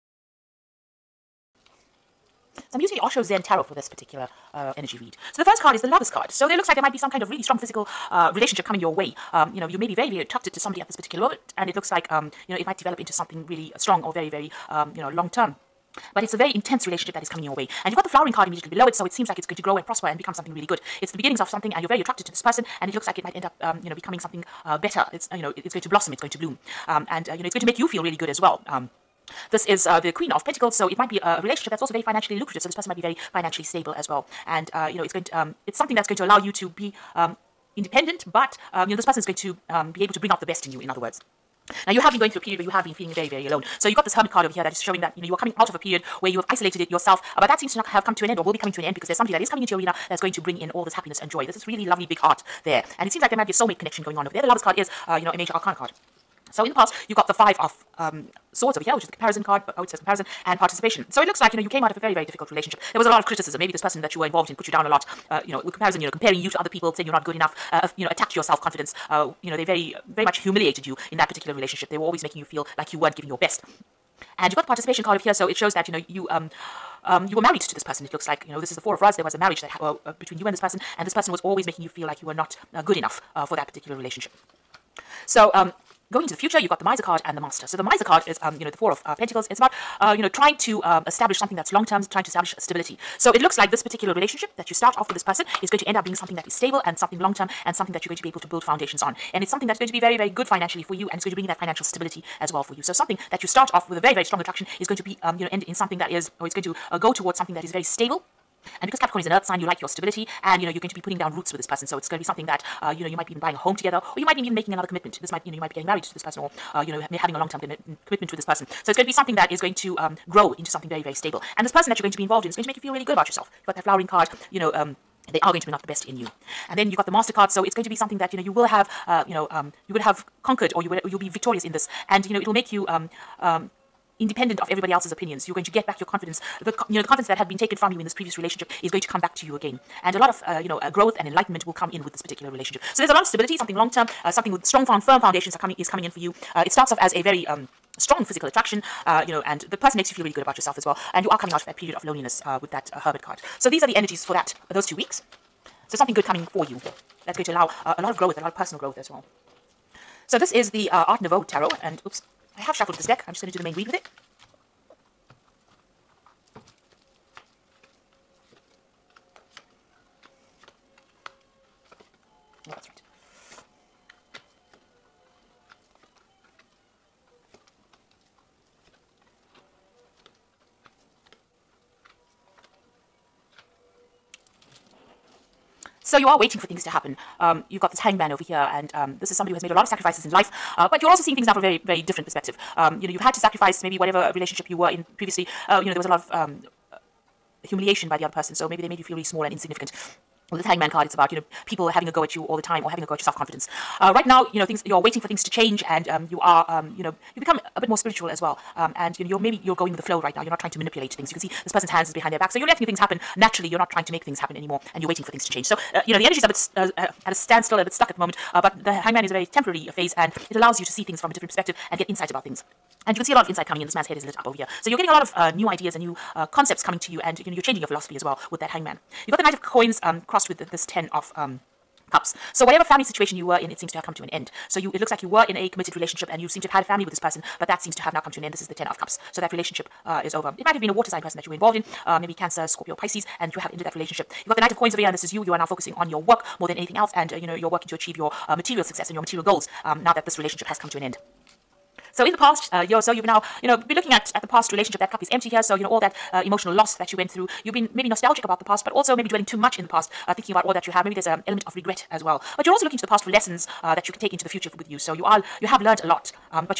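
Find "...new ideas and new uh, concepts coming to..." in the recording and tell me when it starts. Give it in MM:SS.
03:45.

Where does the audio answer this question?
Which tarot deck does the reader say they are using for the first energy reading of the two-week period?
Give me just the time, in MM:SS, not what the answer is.
00:03.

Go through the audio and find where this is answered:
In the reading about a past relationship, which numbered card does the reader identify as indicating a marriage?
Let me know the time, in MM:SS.
01:18.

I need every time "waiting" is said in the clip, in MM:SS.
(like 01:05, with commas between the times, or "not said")
03:06, 03:24, 03:35.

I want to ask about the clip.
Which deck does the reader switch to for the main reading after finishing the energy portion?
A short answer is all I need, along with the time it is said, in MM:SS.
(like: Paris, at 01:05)
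Art Nouveau Tarot, at 02:41.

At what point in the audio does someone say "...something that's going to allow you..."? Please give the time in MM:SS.
00:35.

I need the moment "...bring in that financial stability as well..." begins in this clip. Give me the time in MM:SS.
01:41.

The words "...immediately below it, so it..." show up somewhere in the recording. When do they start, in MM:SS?
00:18.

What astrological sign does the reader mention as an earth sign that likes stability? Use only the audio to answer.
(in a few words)
Capricorn.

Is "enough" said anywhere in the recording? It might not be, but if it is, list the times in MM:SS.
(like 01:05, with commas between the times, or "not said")
01:07, 01:22.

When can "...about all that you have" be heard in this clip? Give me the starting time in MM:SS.
04:20.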